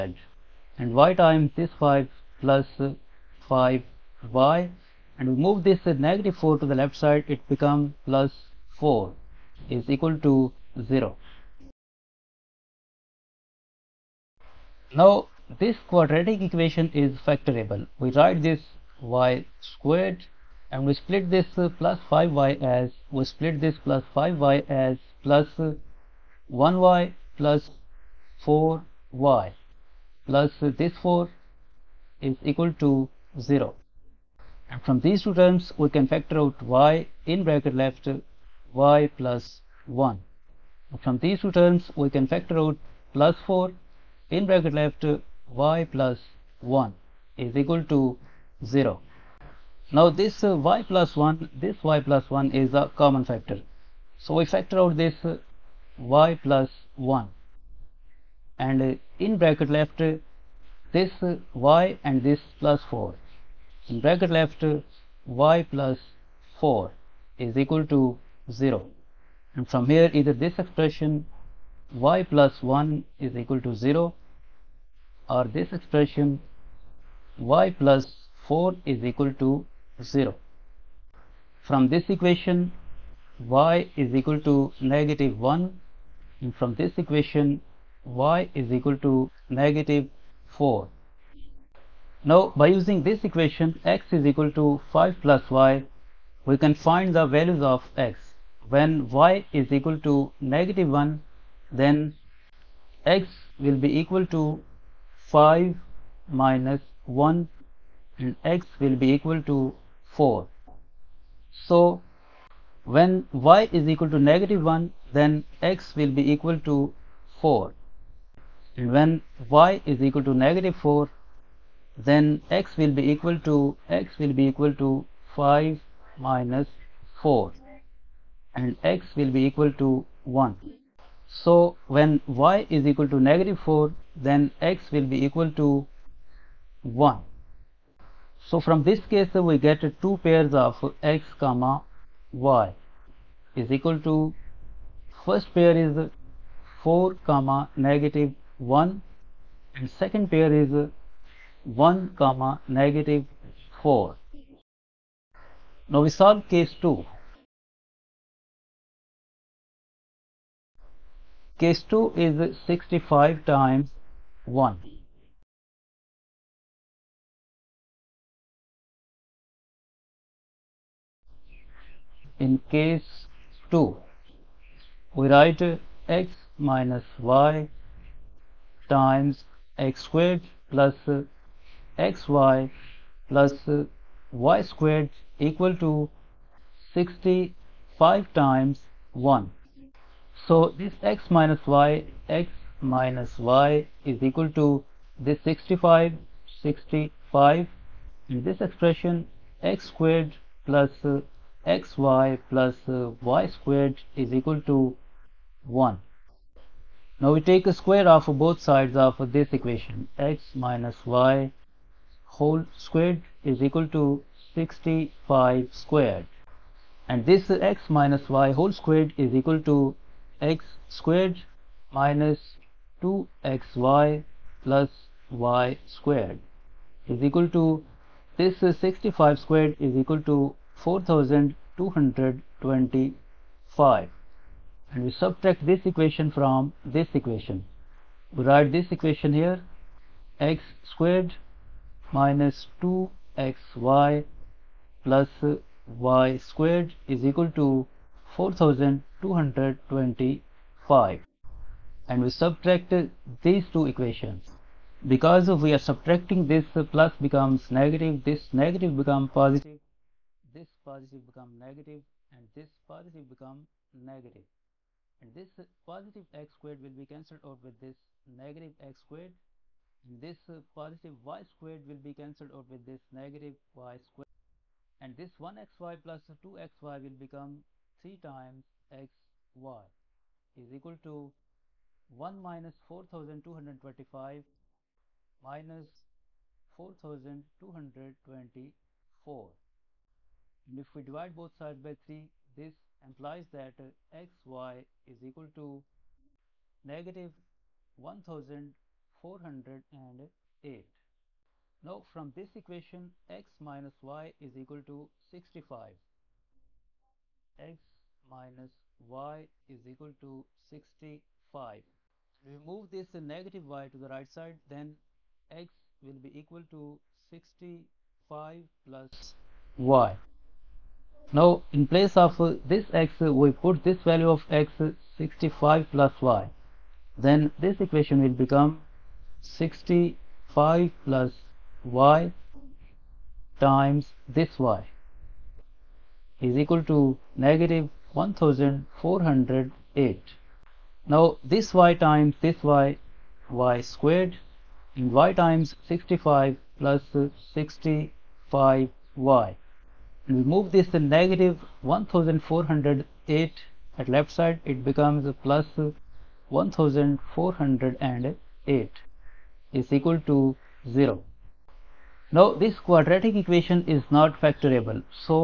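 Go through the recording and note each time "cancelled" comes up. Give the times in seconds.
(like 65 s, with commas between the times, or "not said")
267 s, 272 s.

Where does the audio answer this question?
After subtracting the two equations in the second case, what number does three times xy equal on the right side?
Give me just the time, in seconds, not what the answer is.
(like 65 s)
285 s.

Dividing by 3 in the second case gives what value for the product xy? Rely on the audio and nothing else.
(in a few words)
-1408.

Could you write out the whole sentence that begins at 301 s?
Now from this equation x minus y is equal to 65.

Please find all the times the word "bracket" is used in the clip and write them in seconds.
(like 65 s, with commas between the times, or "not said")
37 s, 44 s, 59 s, 64 s.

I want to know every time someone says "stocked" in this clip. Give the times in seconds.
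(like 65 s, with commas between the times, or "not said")
not said.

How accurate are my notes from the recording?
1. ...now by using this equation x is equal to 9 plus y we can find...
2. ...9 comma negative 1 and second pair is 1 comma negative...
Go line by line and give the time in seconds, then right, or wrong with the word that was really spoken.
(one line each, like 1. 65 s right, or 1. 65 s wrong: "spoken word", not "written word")
1. 92 s wrong: "5", not "9"
2. 146 s wrong: "4", not "9".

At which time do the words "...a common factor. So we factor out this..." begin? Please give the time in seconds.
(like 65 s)
52 s.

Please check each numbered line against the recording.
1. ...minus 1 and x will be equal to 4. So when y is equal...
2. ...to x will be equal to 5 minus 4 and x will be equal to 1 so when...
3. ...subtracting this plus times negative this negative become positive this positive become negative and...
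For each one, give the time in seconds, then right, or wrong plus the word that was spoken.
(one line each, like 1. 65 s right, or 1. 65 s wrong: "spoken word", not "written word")
1. 106 s right
2. 123 s right
3. 255 s wrong: "becomes", not "times".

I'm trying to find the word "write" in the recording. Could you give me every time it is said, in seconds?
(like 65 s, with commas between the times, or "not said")
18 s, 175 s, 238 s.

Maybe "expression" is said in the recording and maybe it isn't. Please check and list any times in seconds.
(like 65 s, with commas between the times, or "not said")
70 s, 75 s, 198 s.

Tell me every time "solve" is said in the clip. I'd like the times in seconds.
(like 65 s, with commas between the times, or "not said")
156 s.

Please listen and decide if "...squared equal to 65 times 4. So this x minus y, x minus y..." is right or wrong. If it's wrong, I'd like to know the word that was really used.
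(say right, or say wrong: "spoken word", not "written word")
wrong: "1", not "4".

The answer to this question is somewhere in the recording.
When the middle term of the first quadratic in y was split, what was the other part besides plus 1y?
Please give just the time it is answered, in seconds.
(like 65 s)
27 s.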